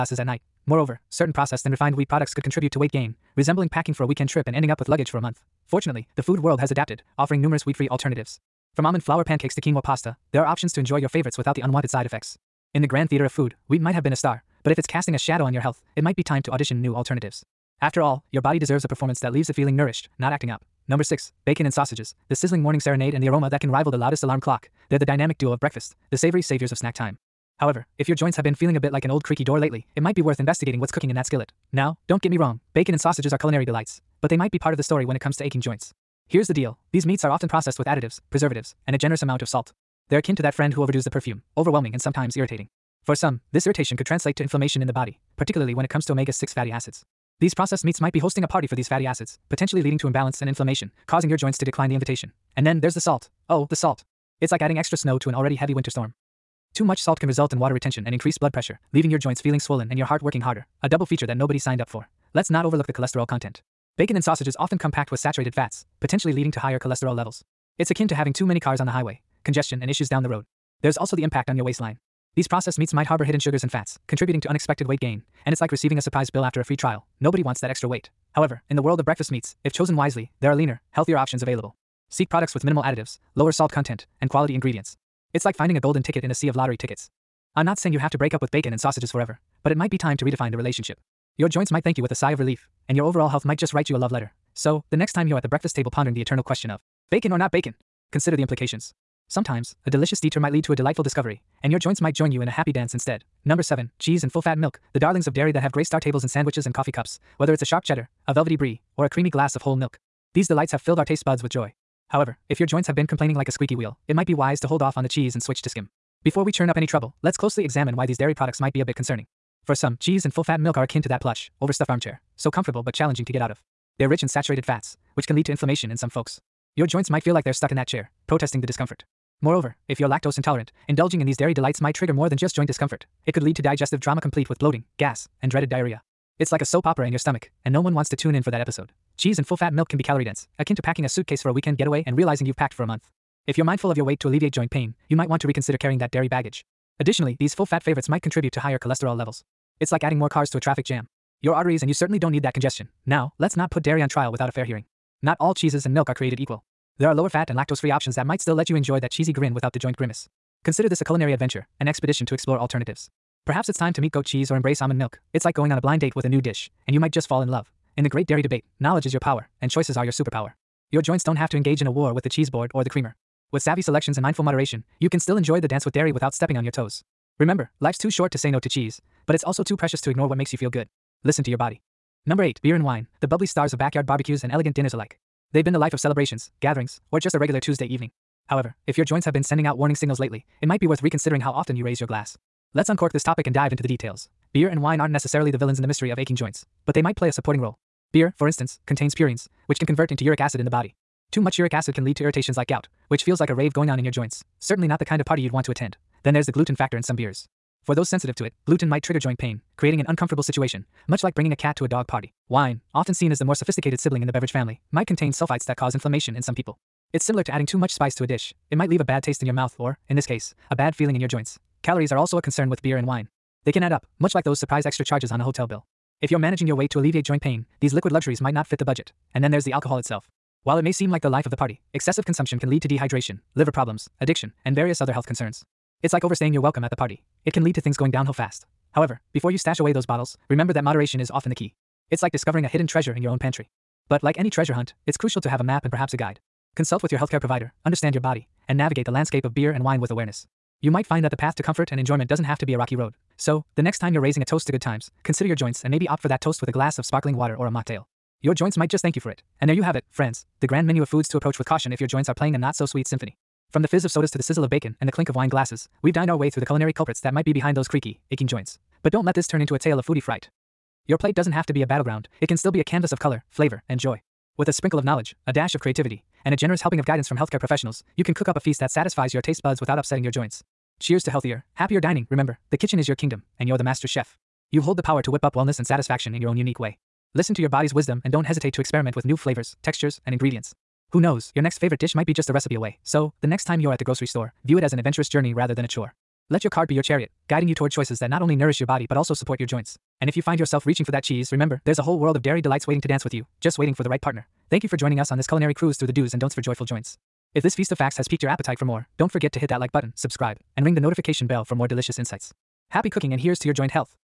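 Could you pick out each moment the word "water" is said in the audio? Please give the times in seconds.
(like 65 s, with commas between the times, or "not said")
57 s, 257 s.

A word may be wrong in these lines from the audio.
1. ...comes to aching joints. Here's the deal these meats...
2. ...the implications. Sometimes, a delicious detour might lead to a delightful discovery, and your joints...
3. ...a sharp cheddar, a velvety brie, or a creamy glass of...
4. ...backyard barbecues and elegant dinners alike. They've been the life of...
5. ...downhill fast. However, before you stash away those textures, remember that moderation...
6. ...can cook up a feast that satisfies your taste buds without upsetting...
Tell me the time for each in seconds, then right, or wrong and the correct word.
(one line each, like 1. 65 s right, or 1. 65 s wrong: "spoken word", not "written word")
1. 35 s right
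2. 98 s right
3. 107 s right
4. 183 s right
5. 238 s wrong: "bottles", not "textures"
6. 278 s right.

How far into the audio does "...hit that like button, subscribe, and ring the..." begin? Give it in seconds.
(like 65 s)
309 s.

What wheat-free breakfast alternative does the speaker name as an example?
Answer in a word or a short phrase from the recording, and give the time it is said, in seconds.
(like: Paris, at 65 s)
almond flour pancakes, at 8 s.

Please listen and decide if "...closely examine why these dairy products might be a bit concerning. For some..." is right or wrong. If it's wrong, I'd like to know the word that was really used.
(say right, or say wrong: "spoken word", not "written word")
right.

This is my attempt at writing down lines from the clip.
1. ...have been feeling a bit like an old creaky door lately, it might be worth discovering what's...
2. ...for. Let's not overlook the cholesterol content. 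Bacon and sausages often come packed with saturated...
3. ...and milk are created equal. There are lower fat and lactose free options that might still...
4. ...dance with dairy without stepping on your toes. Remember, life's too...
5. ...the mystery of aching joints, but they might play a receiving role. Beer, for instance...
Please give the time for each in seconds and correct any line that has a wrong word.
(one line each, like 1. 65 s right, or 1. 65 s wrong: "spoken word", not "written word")
1. 28 s wrong: "investigating", not "discovering"
2. 61 s right
3. 155 s right
4. 175 s right
5. 195 s wrong: "supporting", not "receiving".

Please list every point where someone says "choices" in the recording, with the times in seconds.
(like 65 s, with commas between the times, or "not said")
169 s, 297 s.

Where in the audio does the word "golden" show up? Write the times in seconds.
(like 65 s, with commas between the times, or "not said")
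85 s.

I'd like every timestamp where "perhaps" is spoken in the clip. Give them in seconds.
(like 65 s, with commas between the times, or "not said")
163 s, 245 s.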